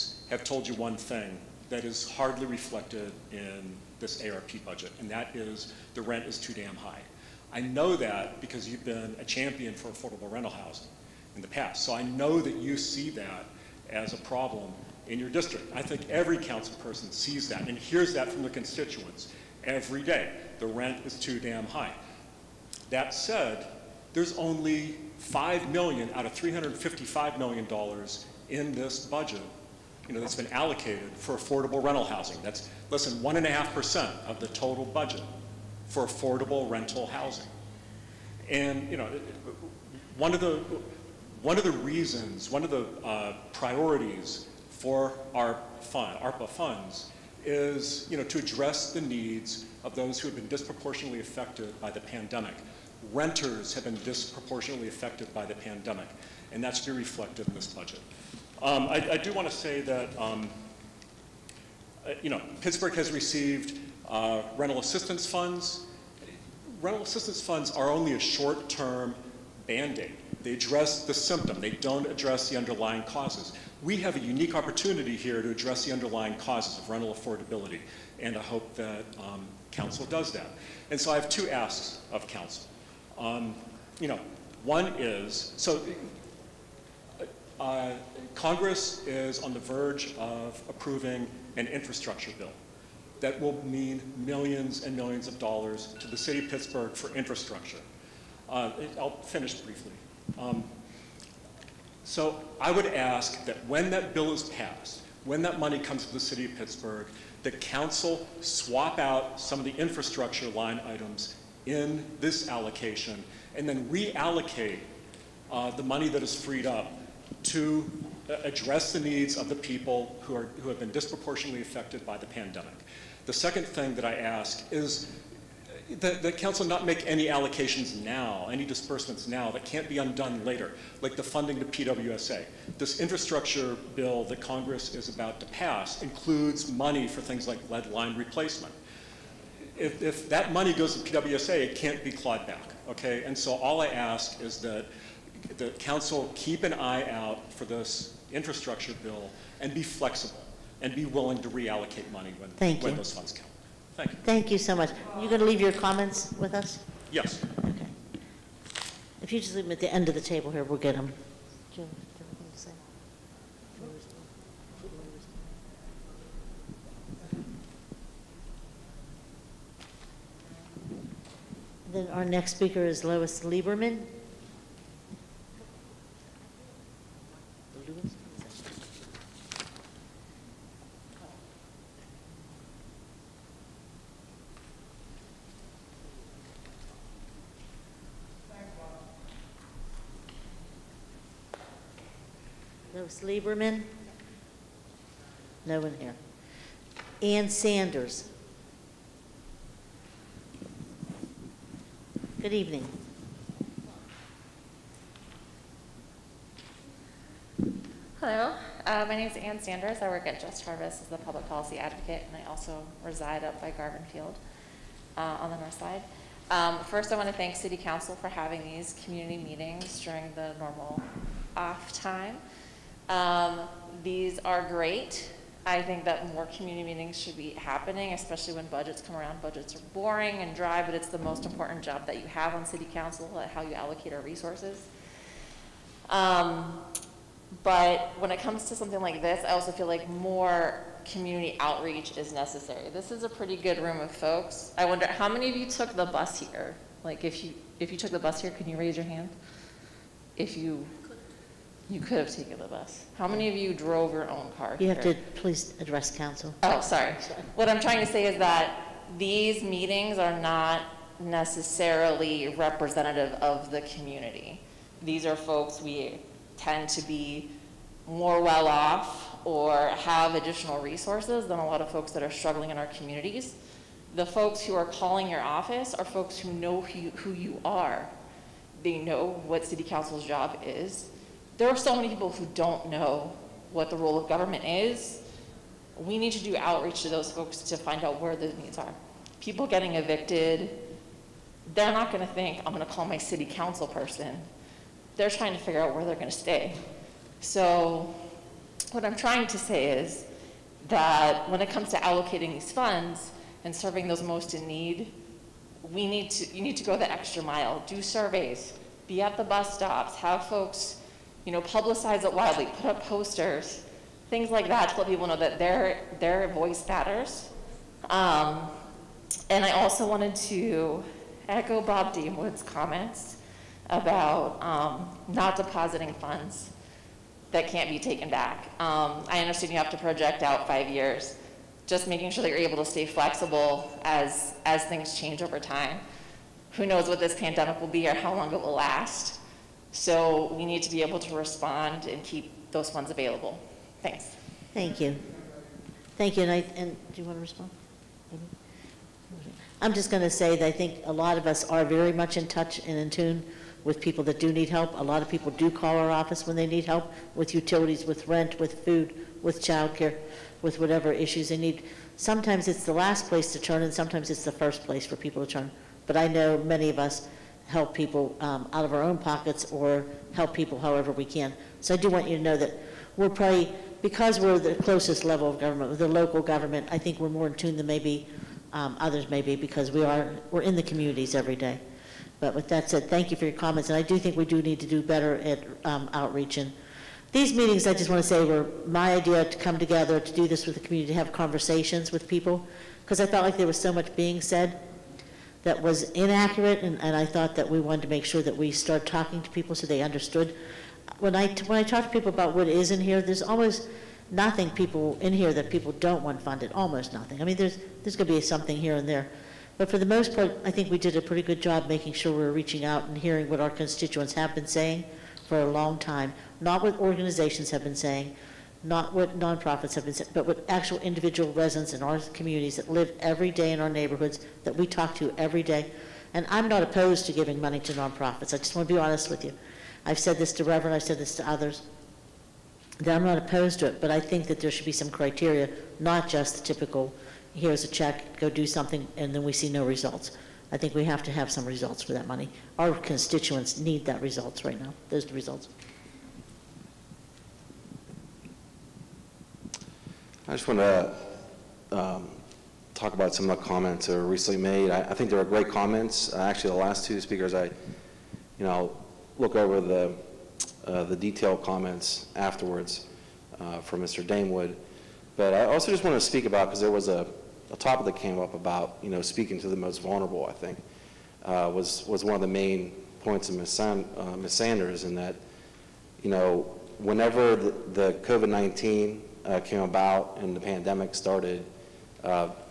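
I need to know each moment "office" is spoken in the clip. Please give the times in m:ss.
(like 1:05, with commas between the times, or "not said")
4:35, 5:56.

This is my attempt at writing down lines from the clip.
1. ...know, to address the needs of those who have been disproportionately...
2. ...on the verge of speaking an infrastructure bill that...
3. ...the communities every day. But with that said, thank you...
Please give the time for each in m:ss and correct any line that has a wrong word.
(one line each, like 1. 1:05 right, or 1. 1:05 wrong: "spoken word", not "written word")
1. 0:48 right
2. 1:29 wrong: "approving", not "speaking"
3. 6:20 right.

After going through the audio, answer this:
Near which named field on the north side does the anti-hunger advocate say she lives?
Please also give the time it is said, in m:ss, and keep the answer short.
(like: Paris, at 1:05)
Garvin Field, at 3:33.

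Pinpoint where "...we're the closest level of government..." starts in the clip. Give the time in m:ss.
6:14.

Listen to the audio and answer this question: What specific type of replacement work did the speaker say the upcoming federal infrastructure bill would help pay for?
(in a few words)
lead line replacement.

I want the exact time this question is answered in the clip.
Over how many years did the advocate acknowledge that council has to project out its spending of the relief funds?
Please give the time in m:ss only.
5:30.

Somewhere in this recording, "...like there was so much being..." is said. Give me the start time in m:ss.
6:33.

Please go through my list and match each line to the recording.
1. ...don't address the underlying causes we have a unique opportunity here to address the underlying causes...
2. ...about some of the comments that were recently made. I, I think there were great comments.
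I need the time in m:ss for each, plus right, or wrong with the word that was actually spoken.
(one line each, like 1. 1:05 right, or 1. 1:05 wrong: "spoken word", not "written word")
1. 1:11 right
2. 7:33 right.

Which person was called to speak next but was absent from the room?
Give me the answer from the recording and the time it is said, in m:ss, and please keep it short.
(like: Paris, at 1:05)
Lois Lieberman, at 2:53.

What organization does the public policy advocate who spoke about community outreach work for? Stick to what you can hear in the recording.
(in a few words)
Just Harvest.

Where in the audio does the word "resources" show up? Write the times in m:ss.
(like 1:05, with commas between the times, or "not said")
3:54, 4:30.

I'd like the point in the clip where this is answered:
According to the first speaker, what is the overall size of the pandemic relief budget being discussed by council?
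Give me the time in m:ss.
0:26.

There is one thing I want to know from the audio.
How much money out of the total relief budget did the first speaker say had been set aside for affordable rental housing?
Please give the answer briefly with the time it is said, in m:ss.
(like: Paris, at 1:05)
5 million, at 0:25.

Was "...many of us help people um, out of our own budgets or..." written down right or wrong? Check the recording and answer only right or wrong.
wrong.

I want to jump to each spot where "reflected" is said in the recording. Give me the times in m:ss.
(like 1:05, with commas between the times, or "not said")
0:02, 0:56.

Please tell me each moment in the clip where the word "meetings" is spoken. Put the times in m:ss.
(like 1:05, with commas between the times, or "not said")
3:39, 3:46, 4:19, 6:27.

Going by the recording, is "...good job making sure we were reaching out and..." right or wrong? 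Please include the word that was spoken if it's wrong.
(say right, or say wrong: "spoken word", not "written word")
right.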